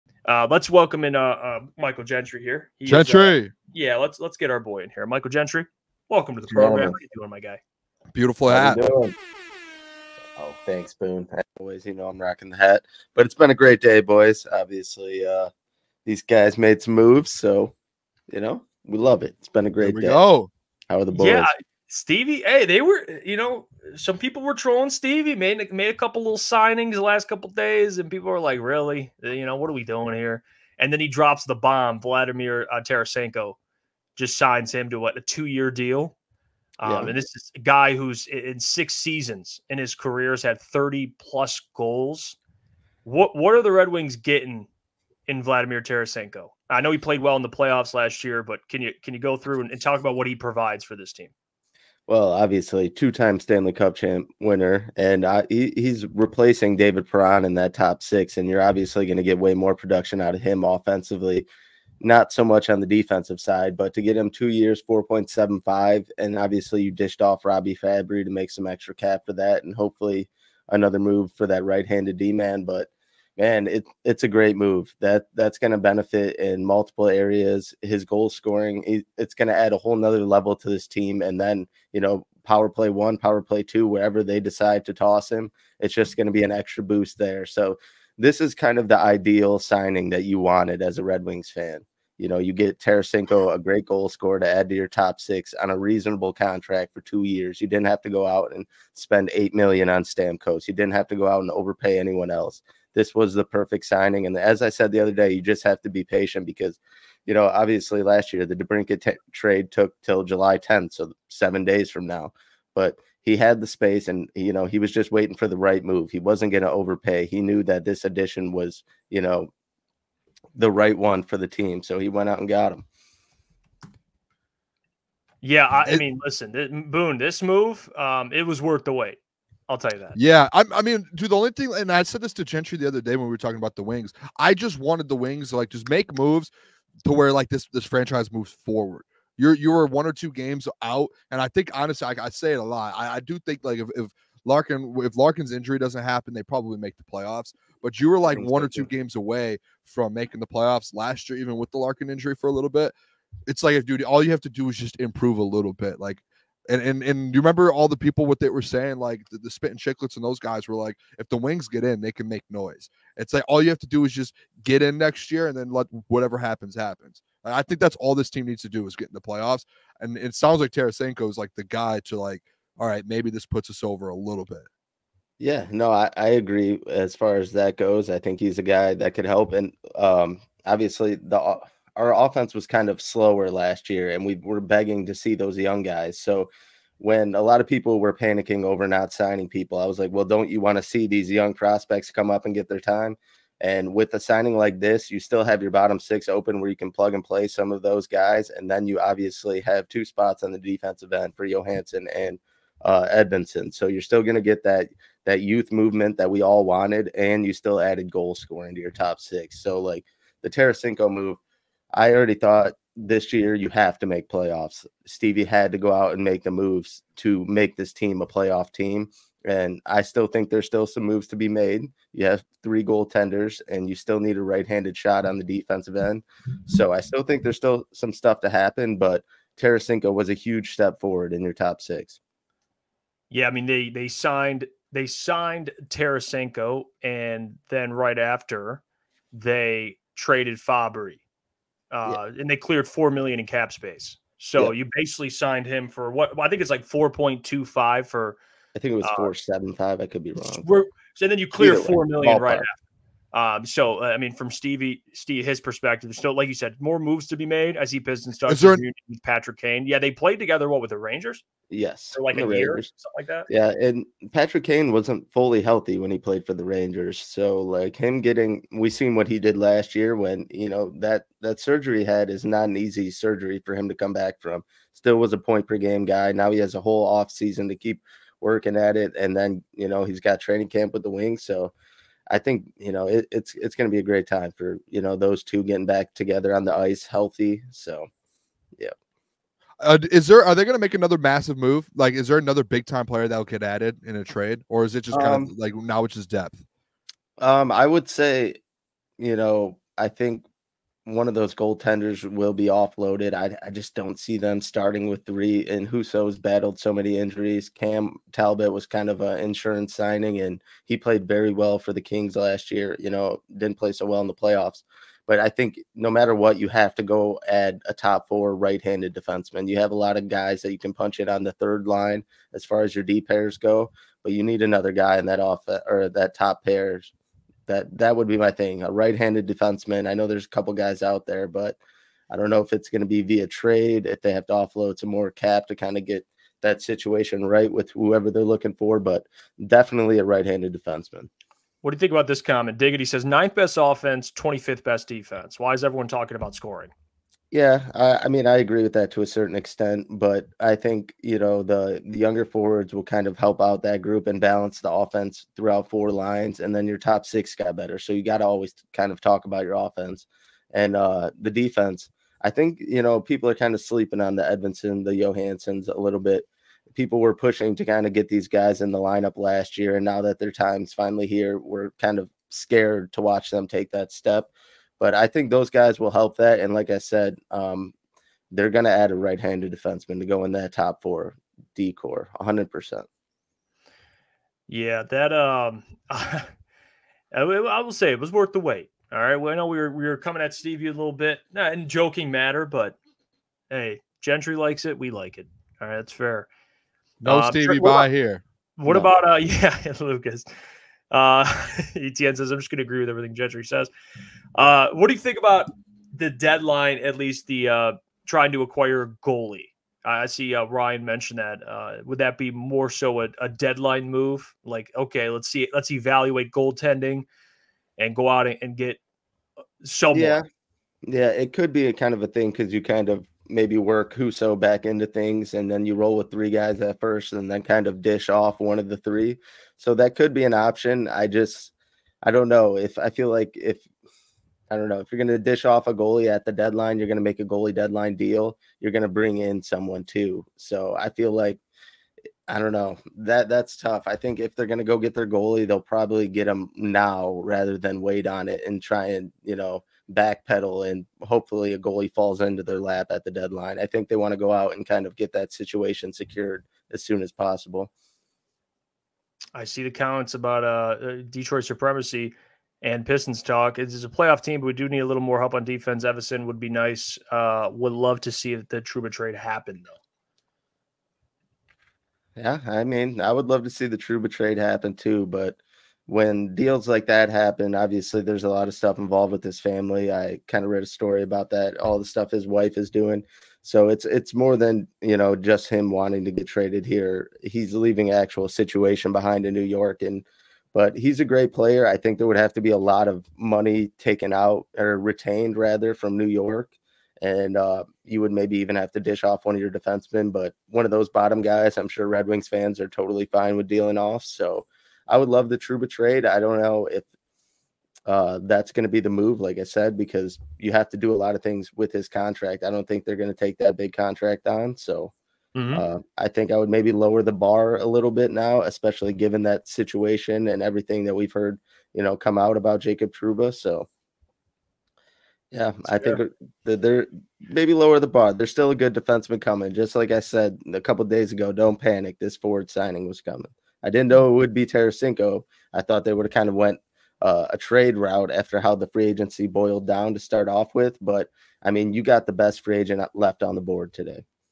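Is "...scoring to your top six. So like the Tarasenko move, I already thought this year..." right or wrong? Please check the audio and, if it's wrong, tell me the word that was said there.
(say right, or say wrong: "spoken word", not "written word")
right.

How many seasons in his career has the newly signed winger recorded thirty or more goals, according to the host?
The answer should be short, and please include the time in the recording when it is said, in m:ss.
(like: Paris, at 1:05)
6, at 0:38.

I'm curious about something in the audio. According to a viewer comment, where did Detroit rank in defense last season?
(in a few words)
25th.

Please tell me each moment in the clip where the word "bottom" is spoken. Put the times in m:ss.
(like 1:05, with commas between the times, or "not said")
3:15, 8:21.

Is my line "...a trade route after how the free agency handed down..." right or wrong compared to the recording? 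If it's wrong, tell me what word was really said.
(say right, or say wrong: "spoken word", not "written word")
wrong: "boiled", not "handed".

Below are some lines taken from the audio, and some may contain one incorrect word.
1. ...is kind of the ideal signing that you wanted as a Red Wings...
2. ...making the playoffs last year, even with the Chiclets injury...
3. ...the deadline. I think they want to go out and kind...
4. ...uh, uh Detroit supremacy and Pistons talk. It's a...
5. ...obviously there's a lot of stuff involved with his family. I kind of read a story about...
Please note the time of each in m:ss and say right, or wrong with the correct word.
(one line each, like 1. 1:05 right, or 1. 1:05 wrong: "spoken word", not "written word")
1. 1:28 right
2. 2:30 wrong: "Larkin", not "Chiclets"
3. 7:33 right
4. 7:40 right
5. 7:57 right.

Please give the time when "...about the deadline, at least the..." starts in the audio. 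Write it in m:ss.
6:45.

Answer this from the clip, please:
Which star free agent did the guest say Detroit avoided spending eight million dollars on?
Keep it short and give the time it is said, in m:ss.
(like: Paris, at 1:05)
Stamkos, at 1:40.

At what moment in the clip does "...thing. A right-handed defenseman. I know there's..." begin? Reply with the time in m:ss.
5:28.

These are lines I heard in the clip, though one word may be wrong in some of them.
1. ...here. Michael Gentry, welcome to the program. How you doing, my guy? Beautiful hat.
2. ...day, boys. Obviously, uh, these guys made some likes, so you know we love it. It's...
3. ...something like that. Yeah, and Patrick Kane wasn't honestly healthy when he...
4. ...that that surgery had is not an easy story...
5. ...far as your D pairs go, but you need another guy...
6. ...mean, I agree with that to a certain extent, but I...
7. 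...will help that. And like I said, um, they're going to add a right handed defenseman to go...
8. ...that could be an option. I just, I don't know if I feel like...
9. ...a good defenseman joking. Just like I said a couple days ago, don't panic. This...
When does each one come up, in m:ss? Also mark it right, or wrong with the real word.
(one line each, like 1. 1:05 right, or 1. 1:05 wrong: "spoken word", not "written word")
1. 0:04 right
2. 0:13 wrong: "moves", not "likes"
3. 4:22 wrong: "fully", not "honestly"
4. 4:30 wrong: "surgery", not "story"
5. 5:22 right
6. 5:48 right
7. 6:15 right
8. 7:09 right
9. 8:48 wrong: "coming", not "joking".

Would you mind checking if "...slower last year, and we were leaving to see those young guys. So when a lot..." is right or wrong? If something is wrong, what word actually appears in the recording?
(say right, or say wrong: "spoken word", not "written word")
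wrong: "begging", not "leaving".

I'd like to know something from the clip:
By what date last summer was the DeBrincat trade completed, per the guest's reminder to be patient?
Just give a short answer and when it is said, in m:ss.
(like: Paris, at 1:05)
July 10, at 1:50.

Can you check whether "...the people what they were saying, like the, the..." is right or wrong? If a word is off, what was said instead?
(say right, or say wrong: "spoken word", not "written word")
right.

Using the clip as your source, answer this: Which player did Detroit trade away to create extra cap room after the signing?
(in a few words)
Robby Fabbri.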